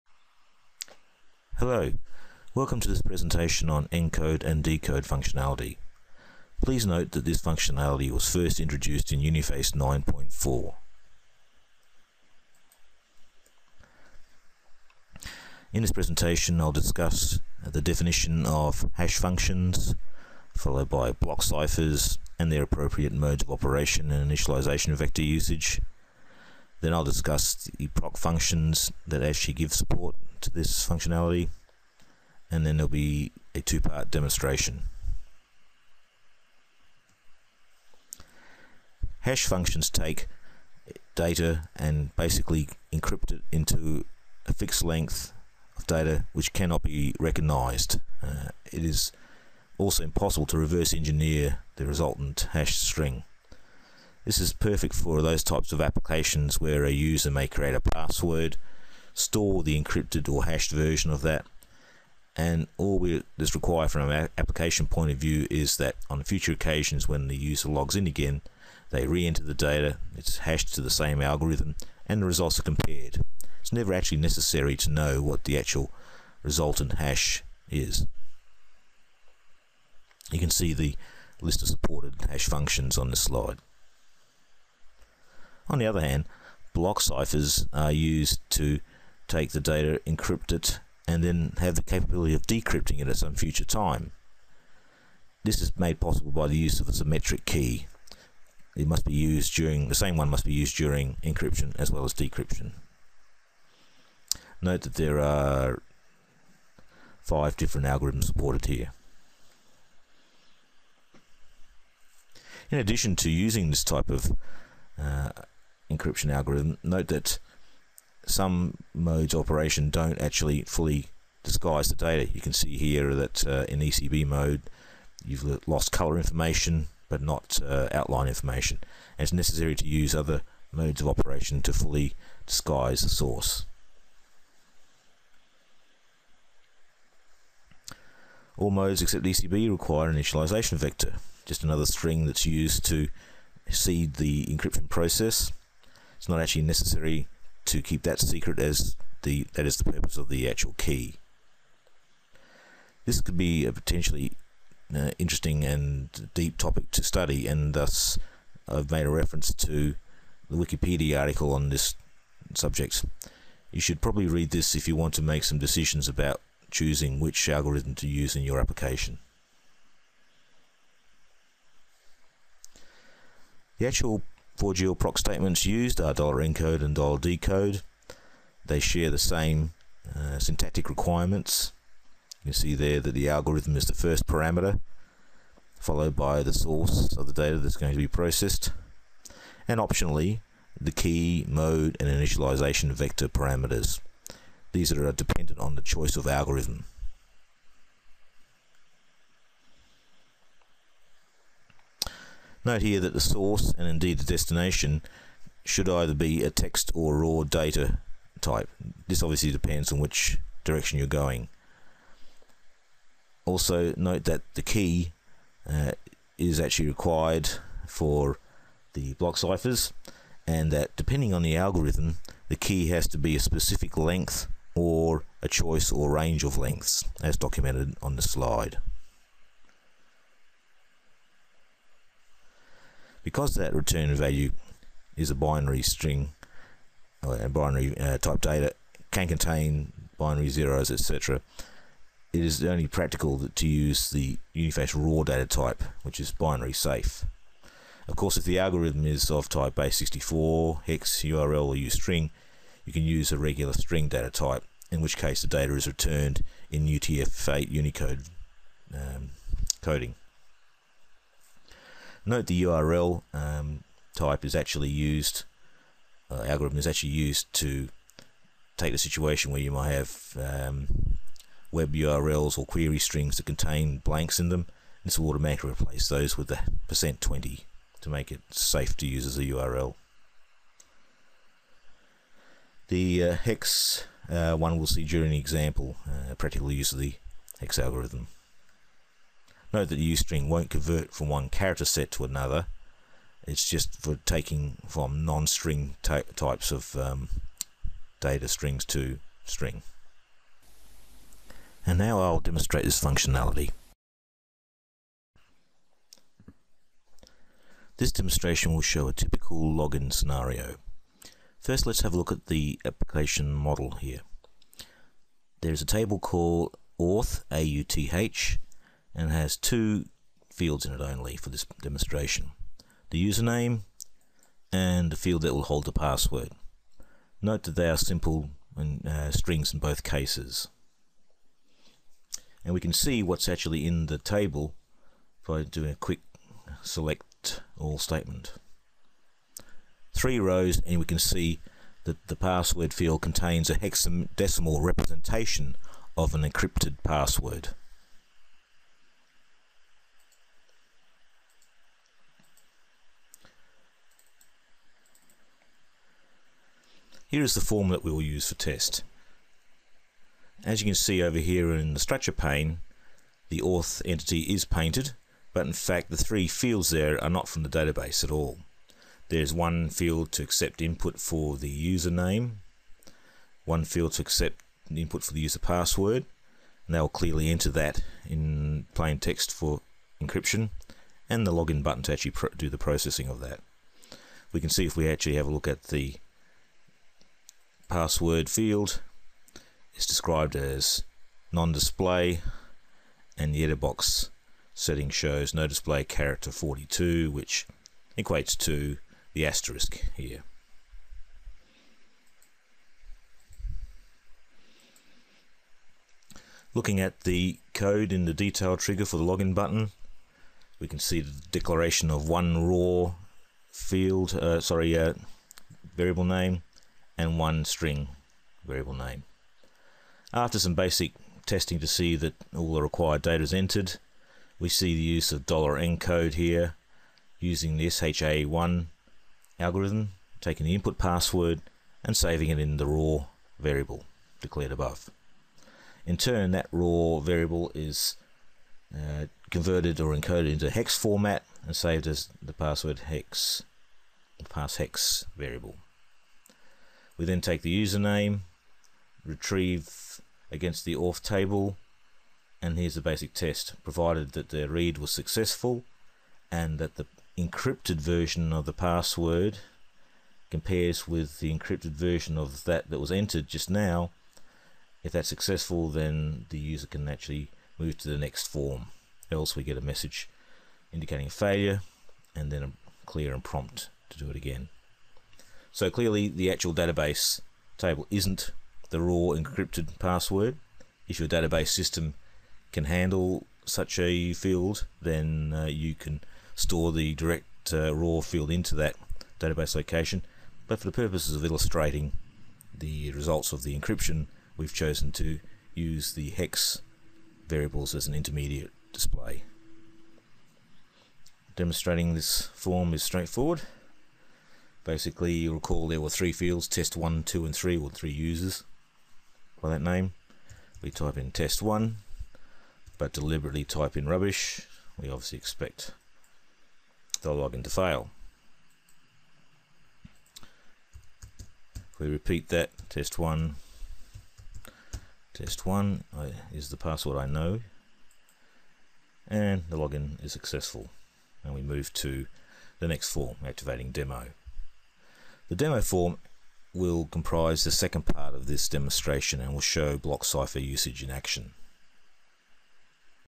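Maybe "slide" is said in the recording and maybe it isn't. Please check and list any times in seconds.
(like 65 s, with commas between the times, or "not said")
83 s, 228 s.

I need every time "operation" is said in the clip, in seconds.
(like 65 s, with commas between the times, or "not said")
23 s, 119 s, 131 s.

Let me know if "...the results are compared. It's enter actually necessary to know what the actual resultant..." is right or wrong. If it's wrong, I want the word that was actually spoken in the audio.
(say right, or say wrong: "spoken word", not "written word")
wrong: "never", not "enter".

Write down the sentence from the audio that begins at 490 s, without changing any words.
But for the purposes of illustrating the results of the encryption, we've chosen to use the hex variables as an intermediate display.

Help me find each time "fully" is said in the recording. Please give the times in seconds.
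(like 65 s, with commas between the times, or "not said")
120 s, 131 s.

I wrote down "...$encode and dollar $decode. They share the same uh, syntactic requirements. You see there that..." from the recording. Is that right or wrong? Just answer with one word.
right.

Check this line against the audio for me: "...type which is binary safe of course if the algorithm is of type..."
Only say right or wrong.
right.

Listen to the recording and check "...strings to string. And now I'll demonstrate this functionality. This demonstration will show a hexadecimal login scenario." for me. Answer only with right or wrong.
wrong.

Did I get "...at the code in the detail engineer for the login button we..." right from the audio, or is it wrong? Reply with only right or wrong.
wrong.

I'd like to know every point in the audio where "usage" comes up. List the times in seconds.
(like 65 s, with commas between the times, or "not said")
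25 s, 540 s.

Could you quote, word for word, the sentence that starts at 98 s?
It must be used during, the same one must be used during encryption as well as decryption.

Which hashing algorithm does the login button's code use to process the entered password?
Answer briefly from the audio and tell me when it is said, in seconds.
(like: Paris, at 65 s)
SHA-1, at 427 s.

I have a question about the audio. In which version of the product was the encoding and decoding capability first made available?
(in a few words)
Uniface 9.4.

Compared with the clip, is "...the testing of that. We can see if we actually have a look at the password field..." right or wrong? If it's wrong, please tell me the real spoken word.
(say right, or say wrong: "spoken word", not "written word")
wrong: "processing", not "testing".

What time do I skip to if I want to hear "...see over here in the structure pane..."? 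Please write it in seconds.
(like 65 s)
360 s.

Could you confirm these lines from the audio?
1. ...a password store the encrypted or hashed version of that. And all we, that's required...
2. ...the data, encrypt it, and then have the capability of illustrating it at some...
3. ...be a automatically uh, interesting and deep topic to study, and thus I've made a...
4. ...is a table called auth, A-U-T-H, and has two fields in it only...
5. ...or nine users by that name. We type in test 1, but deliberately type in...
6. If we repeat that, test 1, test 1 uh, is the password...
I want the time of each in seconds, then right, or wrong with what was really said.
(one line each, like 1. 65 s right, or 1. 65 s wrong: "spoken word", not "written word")
1. 57 s right
2. 89 s wrong: "decrypting", not "illustrating"
3. 153 s wrong: "potentially", not "automatically"
4. 315 s right
5. 507 s wrong: "three", not "nine"
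6. 521 s right.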